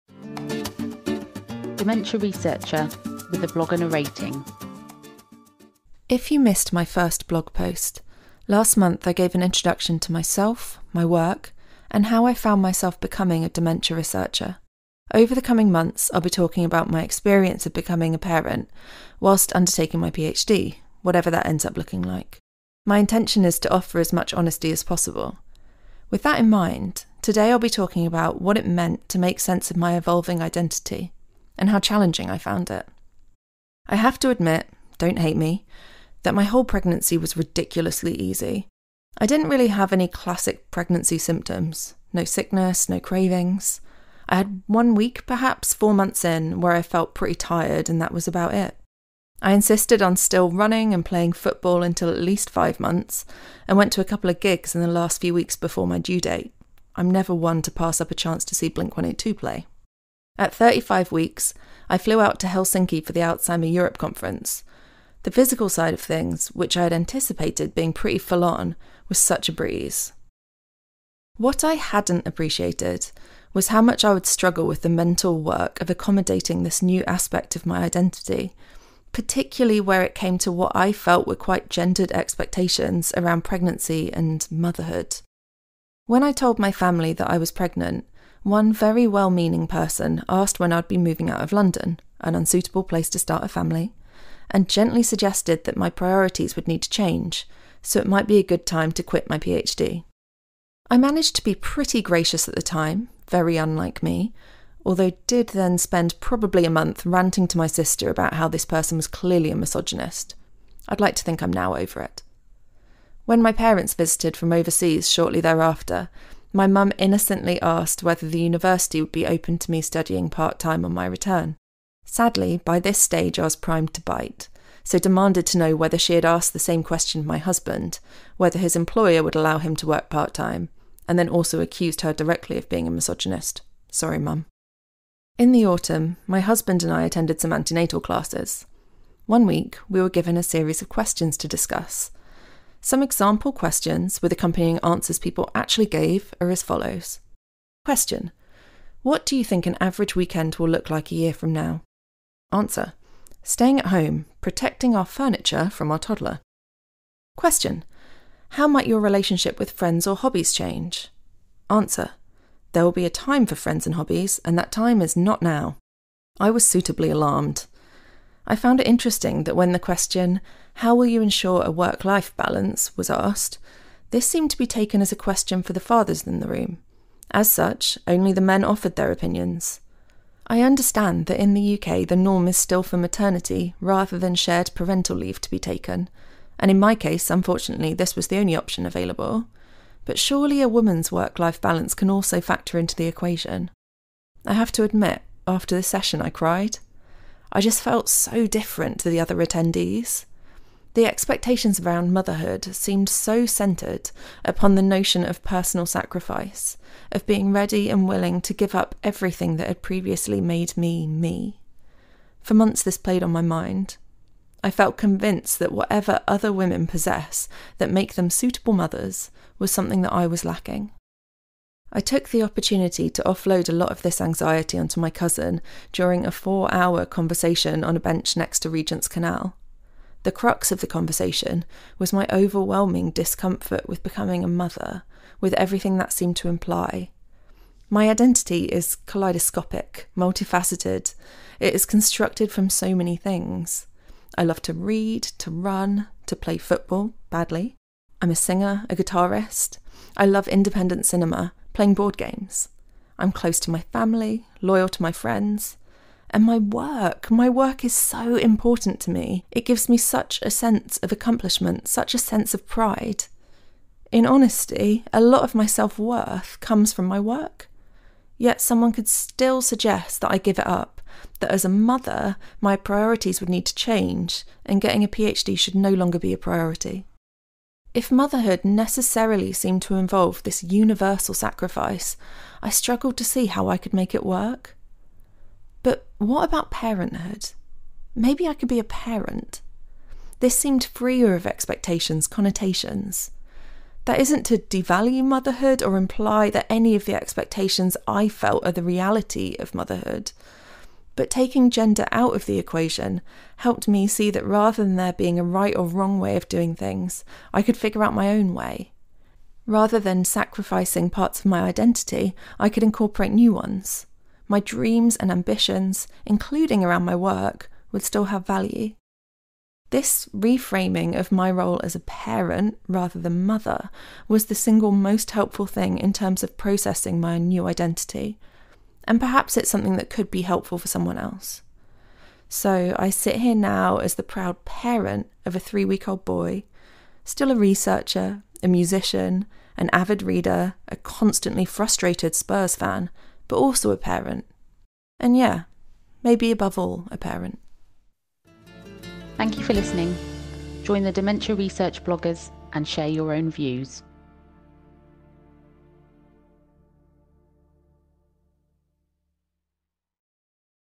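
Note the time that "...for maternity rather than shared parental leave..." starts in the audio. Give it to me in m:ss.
3:02.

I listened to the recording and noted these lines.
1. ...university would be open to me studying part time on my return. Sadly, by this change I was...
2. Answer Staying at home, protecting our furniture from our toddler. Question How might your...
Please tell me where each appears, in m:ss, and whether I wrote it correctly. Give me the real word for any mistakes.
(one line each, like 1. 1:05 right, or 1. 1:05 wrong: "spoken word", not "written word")
1. 1:58 wrong: "stage", not "change"
2. 2:32 right.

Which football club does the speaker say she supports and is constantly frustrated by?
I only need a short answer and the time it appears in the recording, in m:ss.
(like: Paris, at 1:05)
Spurs, at 5:42.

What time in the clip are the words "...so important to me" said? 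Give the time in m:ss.
4:17.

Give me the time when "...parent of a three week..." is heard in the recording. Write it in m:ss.
5:34.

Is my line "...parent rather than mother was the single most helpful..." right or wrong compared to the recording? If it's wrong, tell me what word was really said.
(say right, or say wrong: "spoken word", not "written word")
right.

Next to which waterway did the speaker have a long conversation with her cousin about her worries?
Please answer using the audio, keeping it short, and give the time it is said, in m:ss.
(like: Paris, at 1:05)
Regent's Canal, at 3:48.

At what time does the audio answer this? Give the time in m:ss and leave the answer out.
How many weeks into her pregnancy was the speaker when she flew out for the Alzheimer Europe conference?
1:00.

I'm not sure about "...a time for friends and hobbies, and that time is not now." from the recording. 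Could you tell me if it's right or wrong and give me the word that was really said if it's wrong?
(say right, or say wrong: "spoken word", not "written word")
right.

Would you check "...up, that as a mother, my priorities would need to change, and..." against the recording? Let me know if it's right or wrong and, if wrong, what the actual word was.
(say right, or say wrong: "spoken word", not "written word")
right.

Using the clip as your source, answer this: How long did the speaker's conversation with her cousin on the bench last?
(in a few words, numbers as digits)
4 hours.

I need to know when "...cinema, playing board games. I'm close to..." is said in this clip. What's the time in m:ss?
4:11.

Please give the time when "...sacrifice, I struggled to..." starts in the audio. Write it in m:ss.
4:41.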